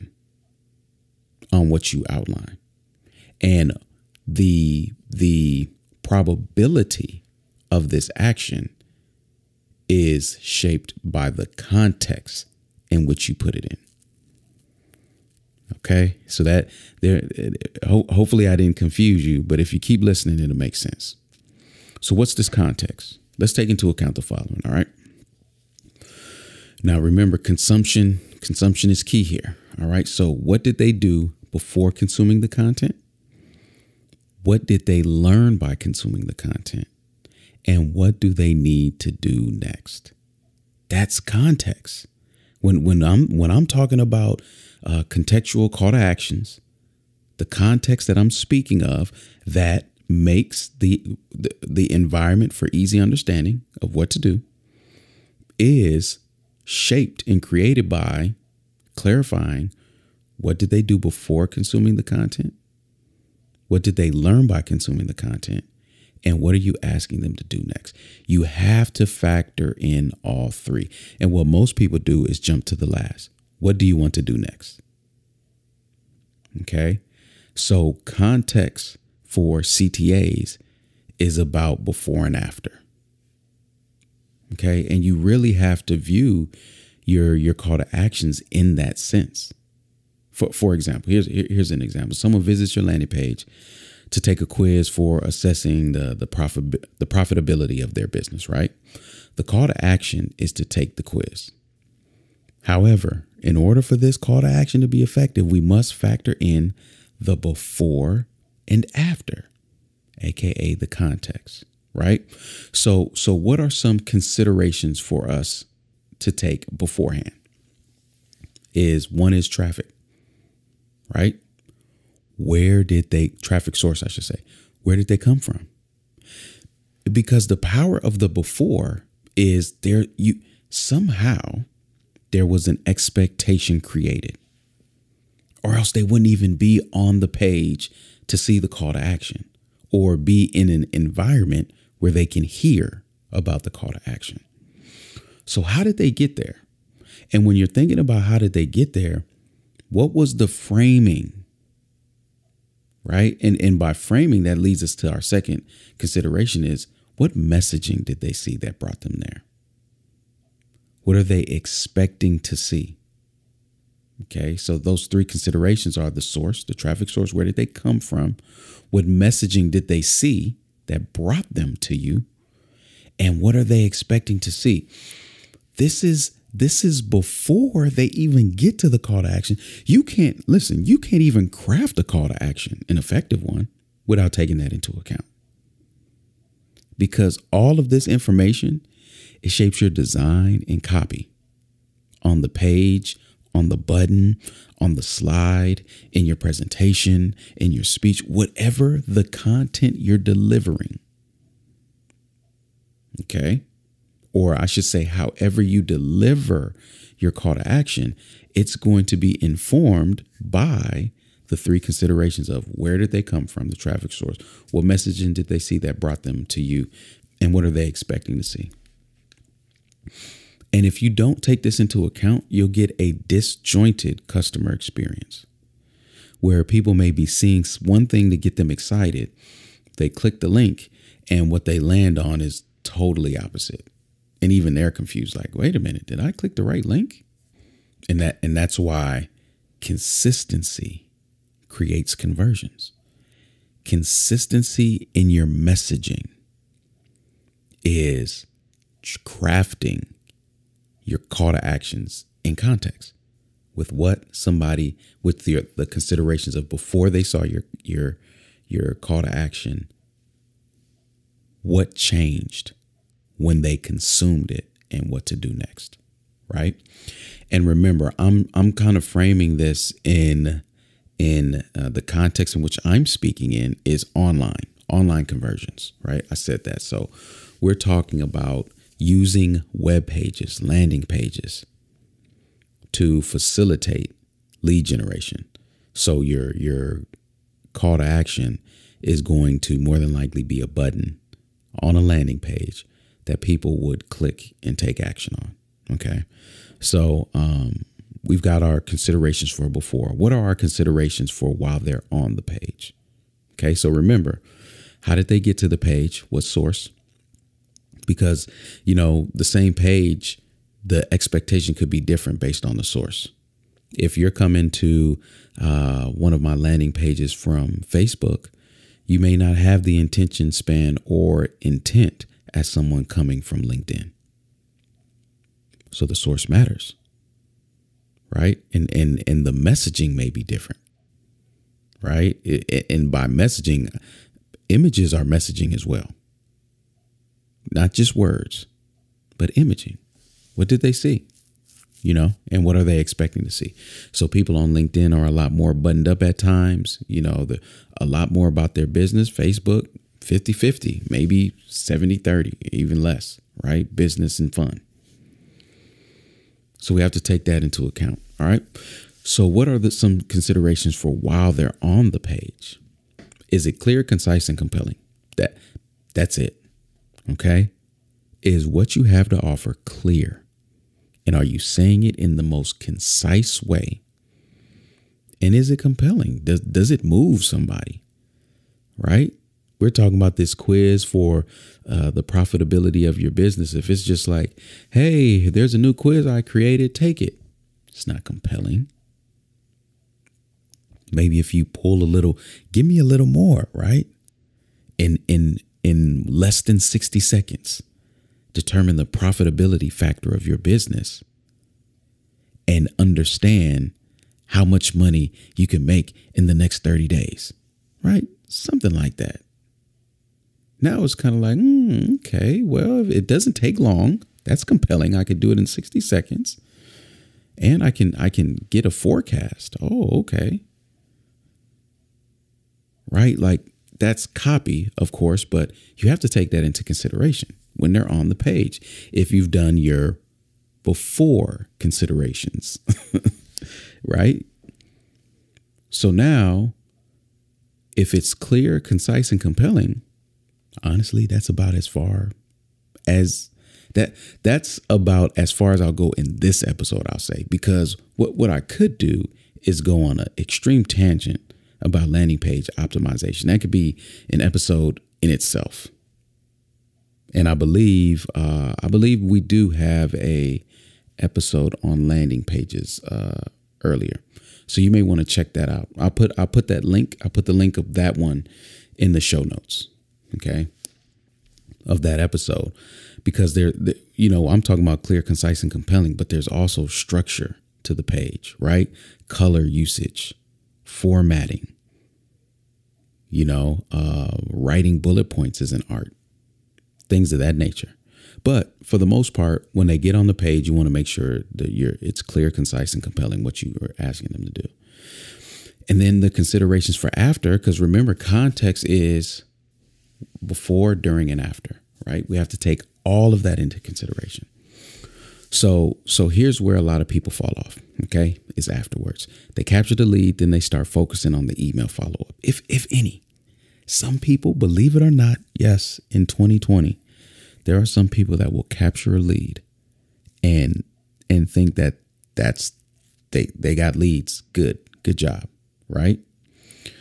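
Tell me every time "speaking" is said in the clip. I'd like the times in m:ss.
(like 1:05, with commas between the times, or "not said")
0:48, 4:33.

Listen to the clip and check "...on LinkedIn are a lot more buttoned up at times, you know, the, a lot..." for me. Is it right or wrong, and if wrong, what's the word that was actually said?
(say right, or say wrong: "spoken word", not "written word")
right.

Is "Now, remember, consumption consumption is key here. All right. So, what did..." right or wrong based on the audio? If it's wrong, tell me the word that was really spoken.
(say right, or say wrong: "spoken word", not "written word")
right.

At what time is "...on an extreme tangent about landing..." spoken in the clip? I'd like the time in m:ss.
7:30.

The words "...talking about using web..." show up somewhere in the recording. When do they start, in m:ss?
4:37.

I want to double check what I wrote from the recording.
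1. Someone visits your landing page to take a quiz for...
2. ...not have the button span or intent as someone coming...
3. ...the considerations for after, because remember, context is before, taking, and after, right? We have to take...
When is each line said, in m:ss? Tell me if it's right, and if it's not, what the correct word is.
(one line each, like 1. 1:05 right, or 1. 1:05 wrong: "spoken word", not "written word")
1. 1:32 right
2. 5:19 wrong: "intention", not "button"
3. 8:16 wrong: "during", not "taking".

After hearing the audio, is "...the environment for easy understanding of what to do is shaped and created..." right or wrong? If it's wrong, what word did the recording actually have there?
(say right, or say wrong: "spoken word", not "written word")
right.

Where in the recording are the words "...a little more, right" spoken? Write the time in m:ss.
6:32.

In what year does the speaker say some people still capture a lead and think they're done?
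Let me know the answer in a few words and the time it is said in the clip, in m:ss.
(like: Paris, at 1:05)
2020, at 8:36.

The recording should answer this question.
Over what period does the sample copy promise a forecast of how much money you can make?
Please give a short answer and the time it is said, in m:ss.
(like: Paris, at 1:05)
Next 30 days, at 6:46.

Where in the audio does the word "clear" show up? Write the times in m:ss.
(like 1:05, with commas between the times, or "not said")
6:03, 6:09, 7:18, 7:55, 8:12.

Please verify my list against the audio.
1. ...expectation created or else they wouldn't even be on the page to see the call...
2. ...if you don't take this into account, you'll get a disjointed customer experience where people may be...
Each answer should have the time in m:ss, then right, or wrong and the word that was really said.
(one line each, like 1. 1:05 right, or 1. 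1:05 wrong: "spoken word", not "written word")
1. 2:12 right
2. 3:40 right.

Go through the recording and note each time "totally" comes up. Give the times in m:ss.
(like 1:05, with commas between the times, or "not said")
3:52.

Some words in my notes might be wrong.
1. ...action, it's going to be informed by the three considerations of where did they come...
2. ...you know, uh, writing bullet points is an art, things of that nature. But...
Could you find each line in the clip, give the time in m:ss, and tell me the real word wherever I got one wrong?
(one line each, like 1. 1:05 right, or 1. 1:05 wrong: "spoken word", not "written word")
1. 3:27 right
2. 8:03 right.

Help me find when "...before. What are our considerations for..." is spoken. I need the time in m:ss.
4:59.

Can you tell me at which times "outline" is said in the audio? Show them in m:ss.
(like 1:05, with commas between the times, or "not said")
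0:02.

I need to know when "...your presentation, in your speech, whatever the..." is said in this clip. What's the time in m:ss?
3:16.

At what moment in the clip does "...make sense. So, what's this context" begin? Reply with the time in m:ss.
0:20.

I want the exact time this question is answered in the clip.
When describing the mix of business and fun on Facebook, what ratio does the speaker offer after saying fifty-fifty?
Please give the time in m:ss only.
5:51.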